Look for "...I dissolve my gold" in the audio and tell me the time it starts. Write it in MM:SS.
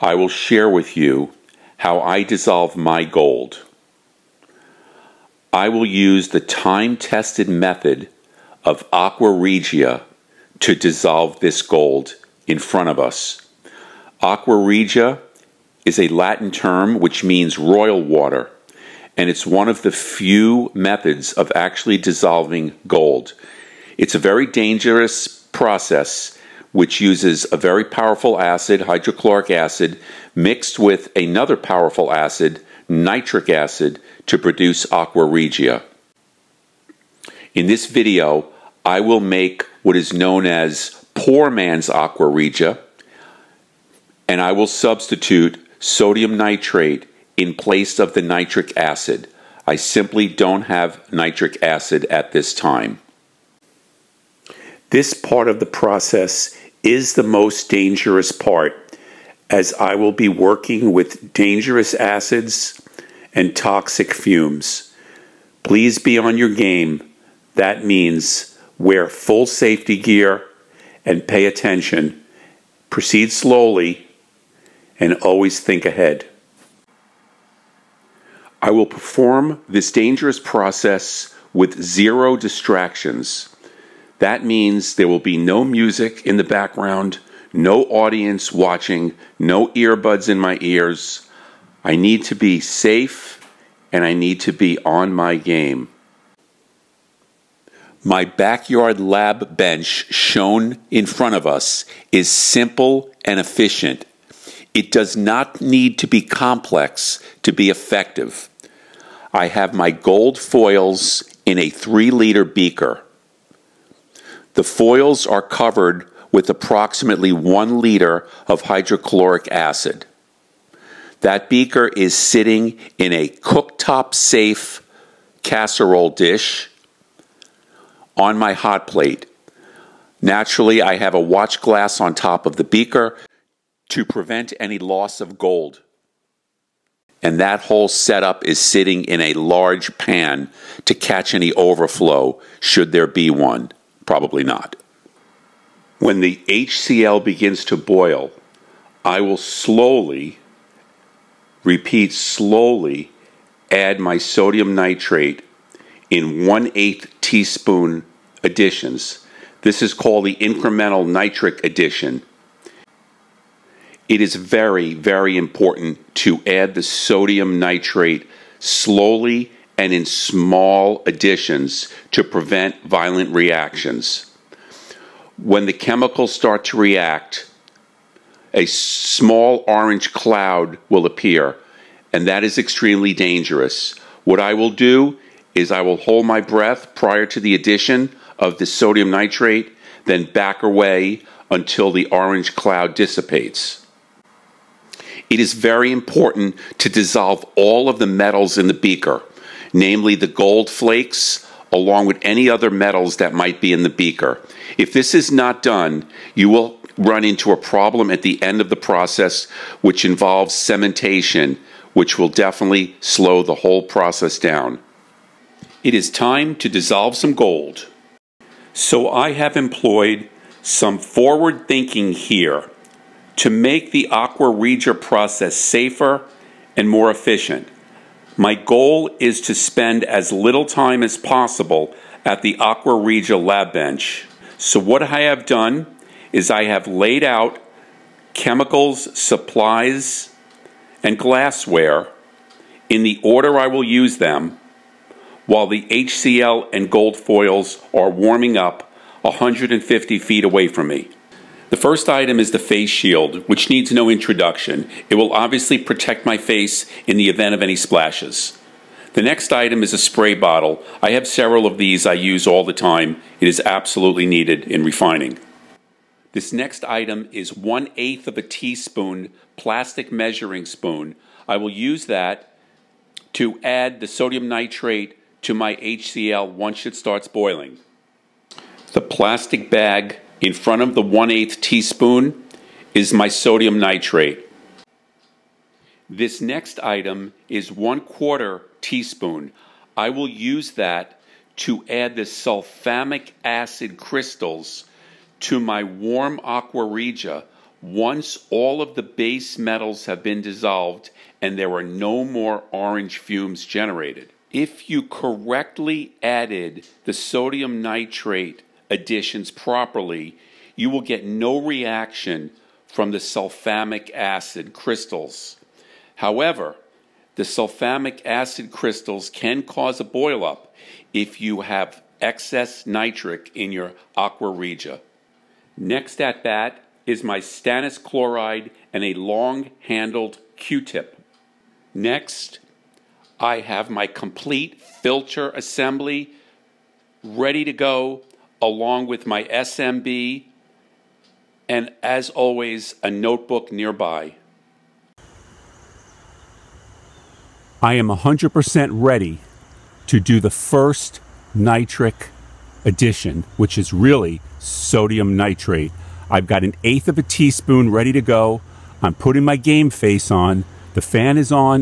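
00:02.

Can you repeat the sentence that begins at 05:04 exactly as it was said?
If you correctly added the sodium nitrate additions properly, you will get no reaction from the sulfamic acid crystals.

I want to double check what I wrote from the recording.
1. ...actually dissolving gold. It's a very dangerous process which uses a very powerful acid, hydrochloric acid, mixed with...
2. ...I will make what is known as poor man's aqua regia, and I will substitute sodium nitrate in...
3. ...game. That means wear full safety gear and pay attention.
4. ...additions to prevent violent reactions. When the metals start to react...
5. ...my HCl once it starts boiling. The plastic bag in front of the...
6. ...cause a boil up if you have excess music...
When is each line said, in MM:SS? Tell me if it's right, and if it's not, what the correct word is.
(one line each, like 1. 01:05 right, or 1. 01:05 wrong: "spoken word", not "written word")
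1. 00:21 right
2. 00:38 right
3. 01:06 right
4. 02:51 wrong: "chemicals", not "metals"
5. 04:35 right
6. 05:19 wrong: "nitric", not "music".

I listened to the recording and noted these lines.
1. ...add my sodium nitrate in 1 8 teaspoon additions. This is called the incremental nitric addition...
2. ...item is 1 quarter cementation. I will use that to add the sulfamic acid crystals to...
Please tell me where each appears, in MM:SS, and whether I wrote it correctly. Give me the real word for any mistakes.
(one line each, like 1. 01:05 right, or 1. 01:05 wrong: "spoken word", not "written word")
1. 02:33 right
2. 04:46 wrong: "teaspoon", not "cementation".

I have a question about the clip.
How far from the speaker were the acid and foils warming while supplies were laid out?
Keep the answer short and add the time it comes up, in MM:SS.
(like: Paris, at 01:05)
150 feet, at 04:09.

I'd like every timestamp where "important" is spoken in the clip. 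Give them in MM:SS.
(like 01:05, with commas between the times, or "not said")
02:45, 03:15.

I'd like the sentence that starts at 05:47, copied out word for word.
I am 100% ready to do the first nitric addition, which is really sodium nitrate.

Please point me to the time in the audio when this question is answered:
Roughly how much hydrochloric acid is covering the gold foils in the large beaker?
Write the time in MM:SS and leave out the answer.
01:57.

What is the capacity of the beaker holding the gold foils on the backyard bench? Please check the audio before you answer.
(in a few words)
3 liters.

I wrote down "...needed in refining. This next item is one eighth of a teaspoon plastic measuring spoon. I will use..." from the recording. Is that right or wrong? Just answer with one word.
right.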